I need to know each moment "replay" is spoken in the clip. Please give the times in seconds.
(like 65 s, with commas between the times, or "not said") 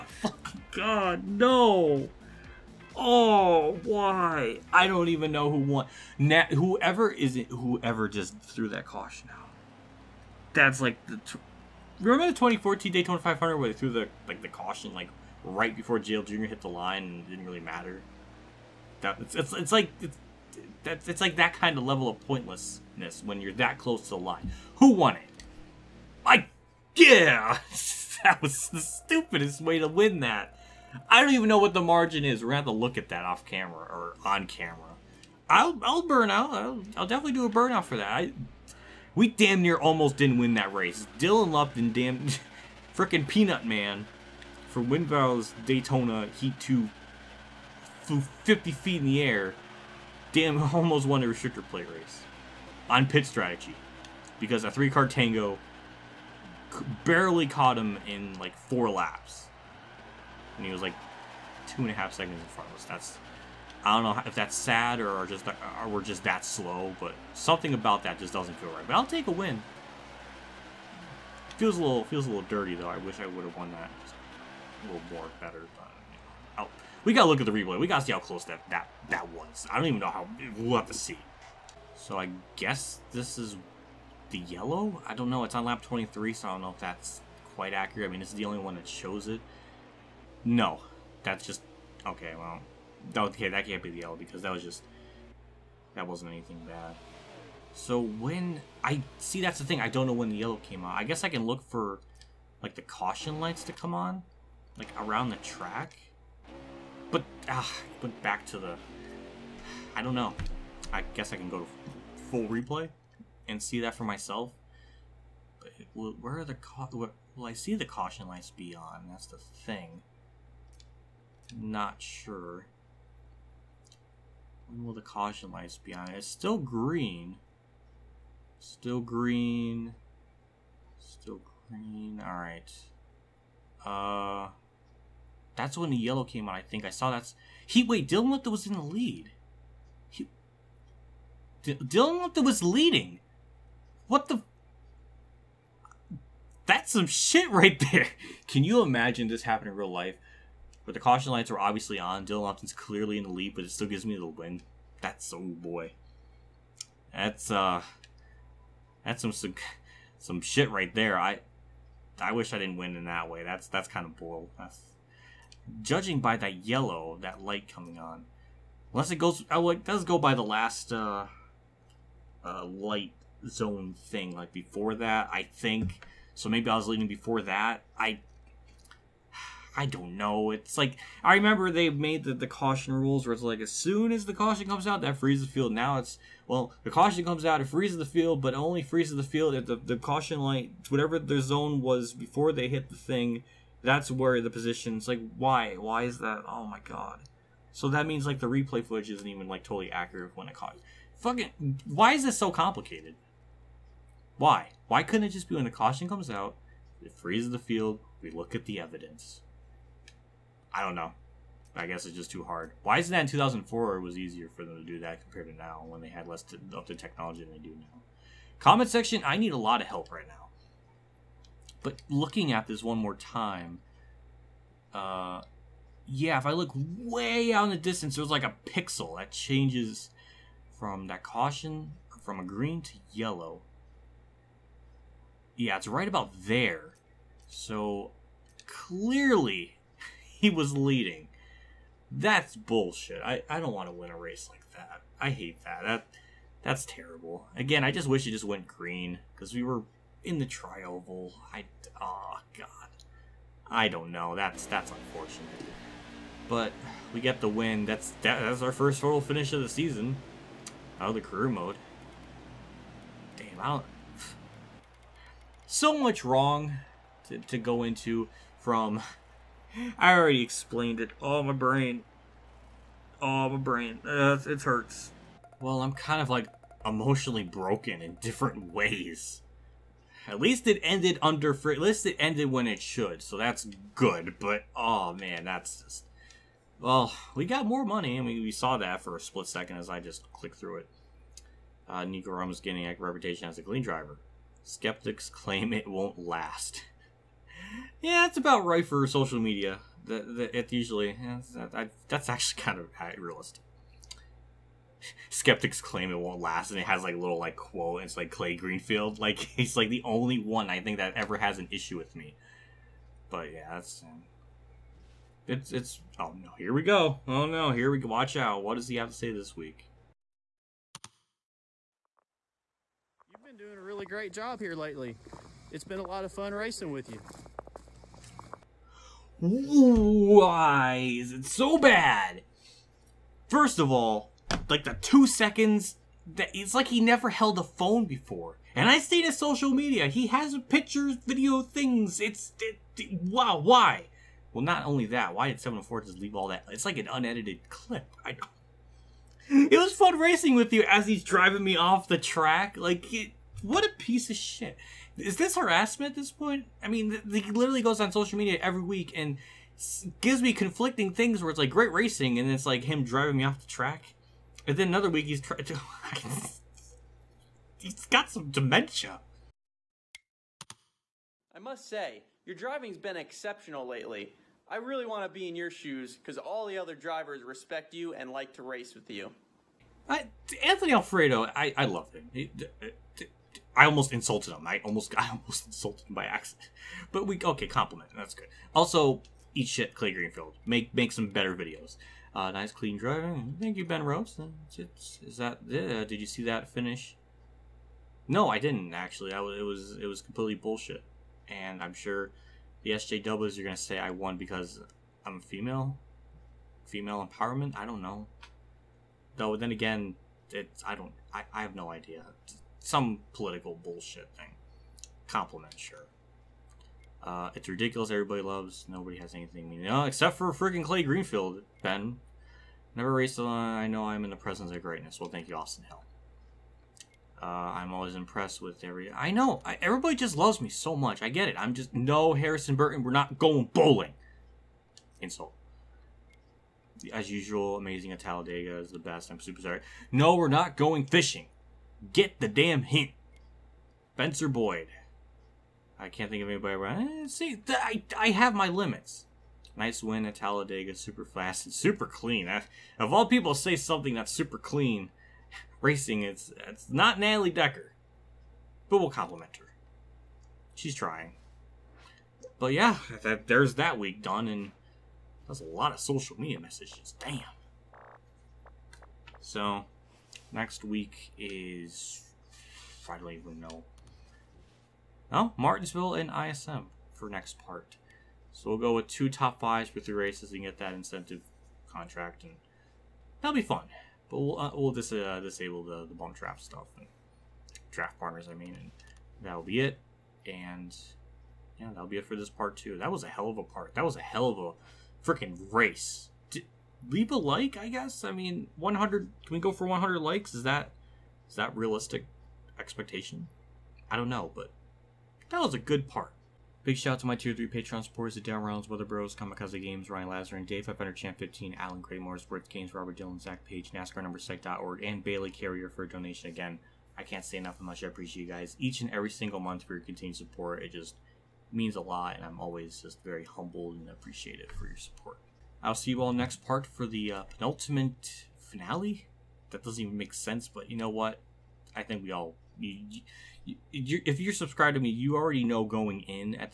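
77 s, 112 s, 198 s.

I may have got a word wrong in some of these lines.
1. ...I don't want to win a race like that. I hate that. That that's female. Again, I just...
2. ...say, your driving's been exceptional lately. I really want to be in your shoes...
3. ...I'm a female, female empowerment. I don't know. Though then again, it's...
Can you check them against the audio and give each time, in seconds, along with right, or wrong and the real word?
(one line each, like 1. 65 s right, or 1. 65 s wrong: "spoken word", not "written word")
1. 243 s wrong: "terrible", not "female"
2. 371 s right
3. 405 s right.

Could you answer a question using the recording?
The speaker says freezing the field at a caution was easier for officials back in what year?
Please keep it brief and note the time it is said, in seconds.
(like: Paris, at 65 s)
2004, at 213 s.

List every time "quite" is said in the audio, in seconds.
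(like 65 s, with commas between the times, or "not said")
87 s.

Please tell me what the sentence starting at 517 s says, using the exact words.
I can't say enough how much I appreciate you guys each and every single month for your continued support.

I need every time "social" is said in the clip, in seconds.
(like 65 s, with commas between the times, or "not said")
299 s, 339 s, 358 s, 466 s.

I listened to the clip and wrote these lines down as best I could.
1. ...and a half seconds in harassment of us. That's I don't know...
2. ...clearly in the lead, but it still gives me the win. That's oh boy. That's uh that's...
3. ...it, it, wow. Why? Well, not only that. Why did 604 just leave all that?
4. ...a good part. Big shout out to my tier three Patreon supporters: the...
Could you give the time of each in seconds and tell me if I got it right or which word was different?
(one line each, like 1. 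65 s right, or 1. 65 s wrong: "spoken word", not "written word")
1. 61 s wrong: "front", not "harassment"
2. 152 s right
3. 342 s wrong: "704", not "604"
4. 505 s right.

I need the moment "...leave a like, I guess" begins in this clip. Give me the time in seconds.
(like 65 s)
497 s.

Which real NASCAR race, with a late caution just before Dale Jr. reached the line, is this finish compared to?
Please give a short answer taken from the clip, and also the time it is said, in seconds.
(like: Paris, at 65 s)
2014 Daytona 500, at 12 s.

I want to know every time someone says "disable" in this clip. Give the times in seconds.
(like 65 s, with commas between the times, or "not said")
485 s.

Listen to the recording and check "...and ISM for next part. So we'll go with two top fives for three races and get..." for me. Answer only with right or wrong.
right.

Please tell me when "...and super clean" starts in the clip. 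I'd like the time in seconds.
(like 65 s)
451 s.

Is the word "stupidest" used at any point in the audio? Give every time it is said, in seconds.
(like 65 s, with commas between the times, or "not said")
28 s.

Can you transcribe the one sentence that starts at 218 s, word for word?
Comment section, I need a lot of help right now.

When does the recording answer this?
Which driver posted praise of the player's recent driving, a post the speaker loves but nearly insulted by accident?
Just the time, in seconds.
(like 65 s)
380 s.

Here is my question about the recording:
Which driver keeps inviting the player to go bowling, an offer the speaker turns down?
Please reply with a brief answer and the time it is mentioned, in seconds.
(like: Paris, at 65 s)
Harrison Burton, at 432 s.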